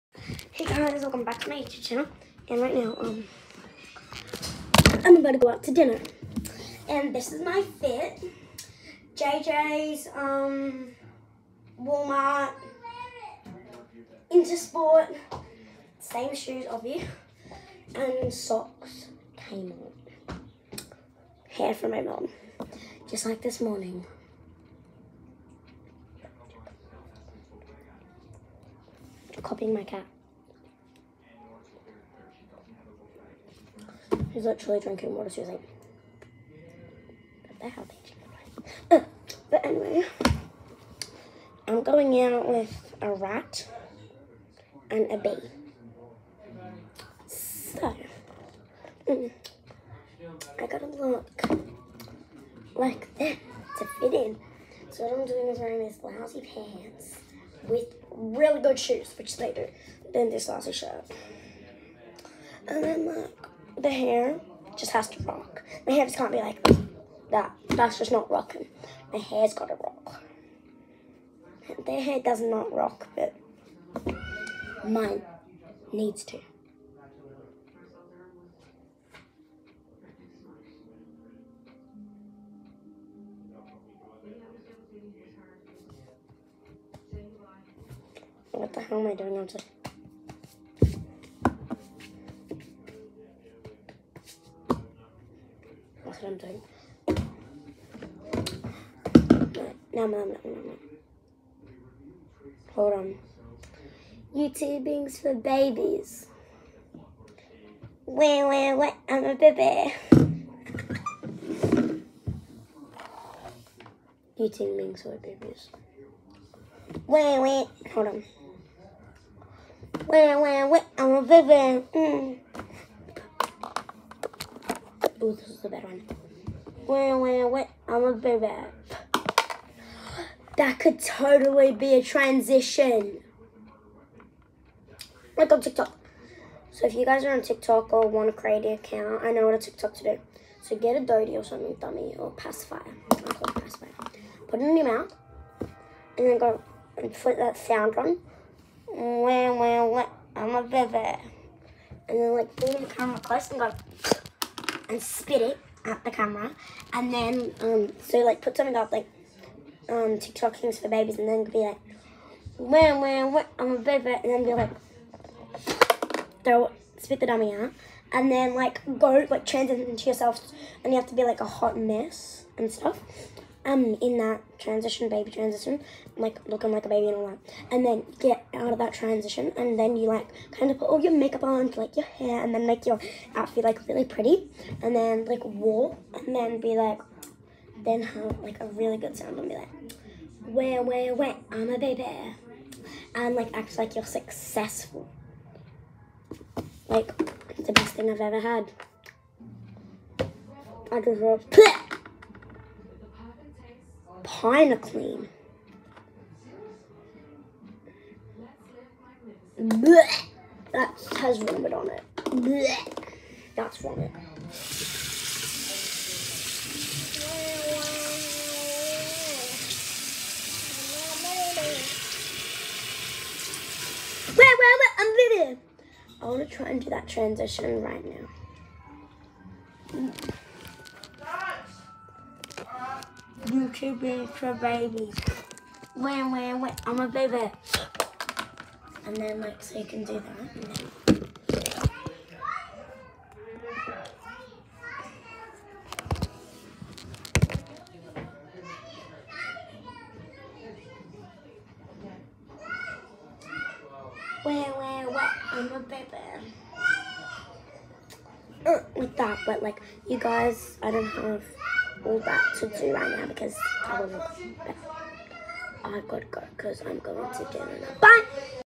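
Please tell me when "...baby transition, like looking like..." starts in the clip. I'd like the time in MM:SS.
02:55.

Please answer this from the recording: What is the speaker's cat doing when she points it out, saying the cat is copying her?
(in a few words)
Drinking water.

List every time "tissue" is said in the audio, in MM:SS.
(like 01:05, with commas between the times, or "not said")
not said.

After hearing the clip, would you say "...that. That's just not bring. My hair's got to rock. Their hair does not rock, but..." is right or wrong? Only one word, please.
wrong.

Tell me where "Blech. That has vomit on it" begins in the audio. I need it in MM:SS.
03:29.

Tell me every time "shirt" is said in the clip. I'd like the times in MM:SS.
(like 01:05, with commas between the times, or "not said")
01:00.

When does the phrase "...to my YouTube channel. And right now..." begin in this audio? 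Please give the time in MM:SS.
00:01.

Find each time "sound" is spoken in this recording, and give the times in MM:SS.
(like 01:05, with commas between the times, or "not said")
02:27, 03:09.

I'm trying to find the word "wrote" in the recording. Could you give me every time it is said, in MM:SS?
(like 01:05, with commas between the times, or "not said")
03:21.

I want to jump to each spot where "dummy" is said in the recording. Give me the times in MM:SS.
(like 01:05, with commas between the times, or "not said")
02:21, 02:47.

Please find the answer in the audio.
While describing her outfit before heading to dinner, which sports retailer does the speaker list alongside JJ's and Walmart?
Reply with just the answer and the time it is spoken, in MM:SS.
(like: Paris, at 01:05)
Intersport, at 00:14.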